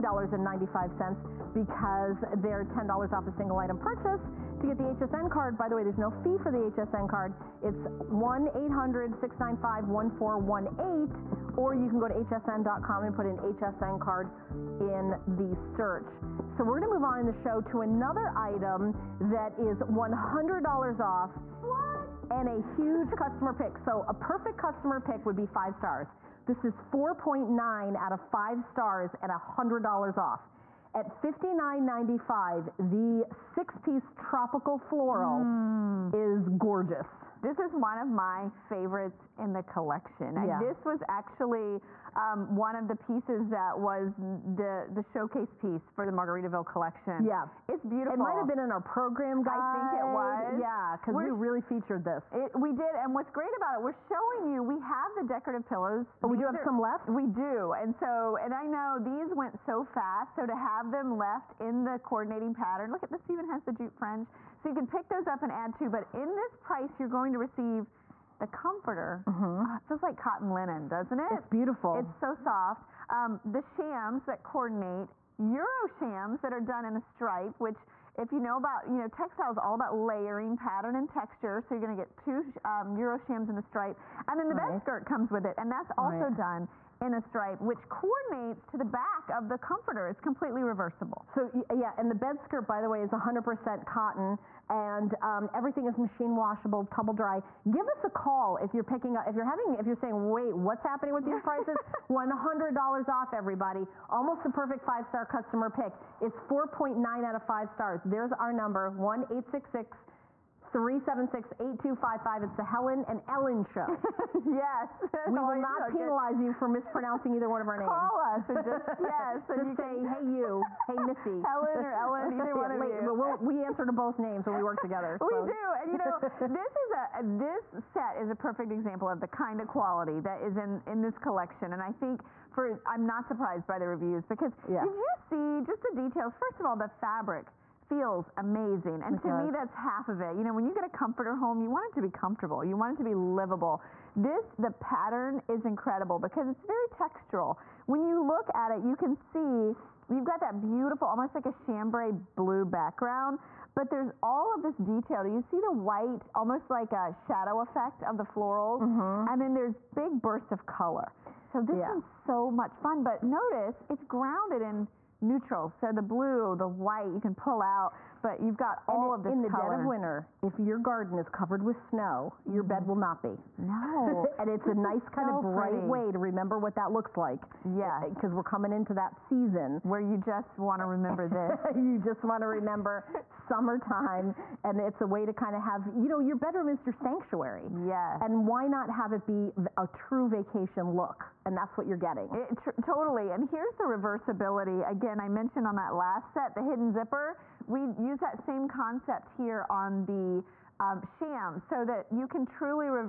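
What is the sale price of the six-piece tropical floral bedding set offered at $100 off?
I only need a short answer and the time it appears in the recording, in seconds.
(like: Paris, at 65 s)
$59.95, at 31 s.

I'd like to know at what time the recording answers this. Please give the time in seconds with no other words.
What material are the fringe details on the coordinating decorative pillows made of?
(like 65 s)
63 s.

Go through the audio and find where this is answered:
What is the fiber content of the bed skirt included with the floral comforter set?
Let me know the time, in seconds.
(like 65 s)
93 s.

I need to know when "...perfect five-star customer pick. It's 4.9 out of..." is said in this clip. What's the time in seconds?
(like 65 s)
104 s.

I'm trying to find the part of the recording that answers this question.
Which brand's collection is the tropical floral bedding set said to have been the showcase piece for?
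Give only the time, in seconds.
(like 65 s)
46 s.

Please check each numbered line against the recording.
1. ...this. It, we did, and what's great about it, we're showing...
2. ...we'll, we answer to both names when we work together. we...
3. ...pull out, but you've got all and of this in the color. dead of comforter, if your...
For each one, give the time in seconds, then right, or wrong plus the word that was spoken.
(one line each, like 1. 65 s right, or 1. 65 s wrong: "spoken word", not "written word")
1. 52 s right
2. 123 s right
3. 167 s wrong: "winter", not "comforter".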